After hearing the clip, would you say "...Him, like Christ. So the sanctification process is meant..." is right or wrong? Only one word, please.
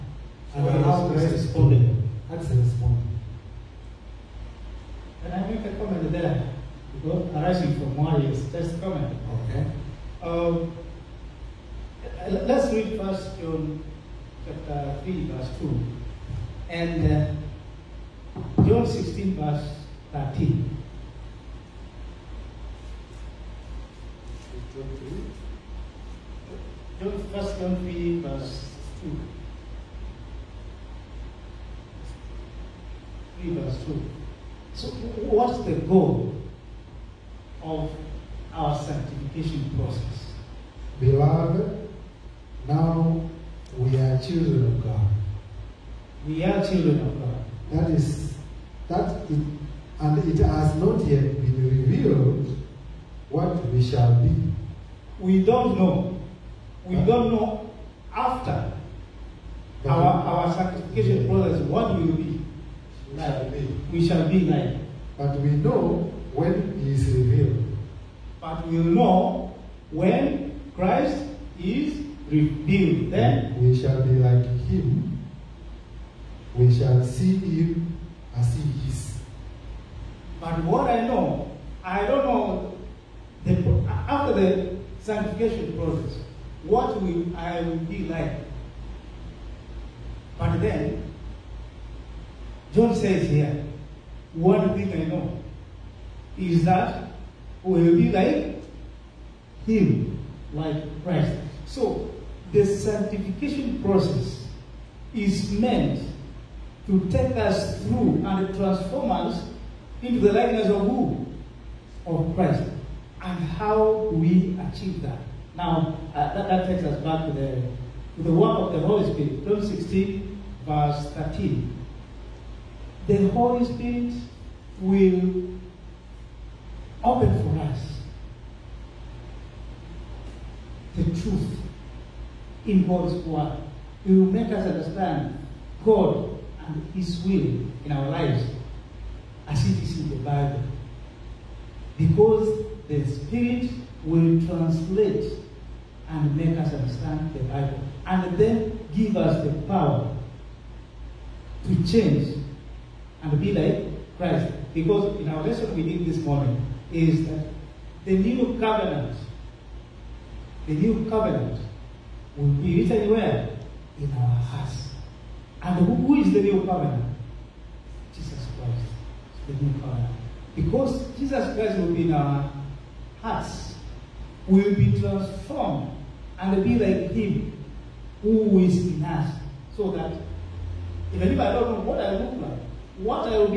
right.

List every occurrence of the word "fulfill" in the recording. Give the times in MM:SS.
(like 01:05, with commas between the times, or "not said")
not said.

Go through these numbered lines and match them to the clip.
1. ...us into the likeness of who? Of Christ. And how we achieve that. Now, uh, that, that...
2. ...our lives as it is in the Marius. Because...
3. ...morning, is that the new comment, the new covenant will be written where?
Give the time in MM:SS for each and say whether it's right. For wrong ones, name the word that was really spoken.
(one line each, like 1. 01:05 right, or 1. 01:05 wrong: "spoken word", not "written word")
1. 01:49 right
2. 02:17 wrong: "Bible", not "Marius"
3. 02:36 wrong: "covenant", not "comment".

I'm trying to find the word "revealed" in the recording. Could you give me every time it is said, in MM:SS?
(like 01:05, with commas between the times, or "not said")
00:51, 01:07, 01:12.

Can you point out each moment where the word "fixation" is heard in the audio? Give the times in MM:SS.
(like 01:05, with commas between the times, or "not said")
not said.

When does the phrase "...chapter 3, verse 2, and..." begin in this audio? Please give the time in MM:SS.
00:14.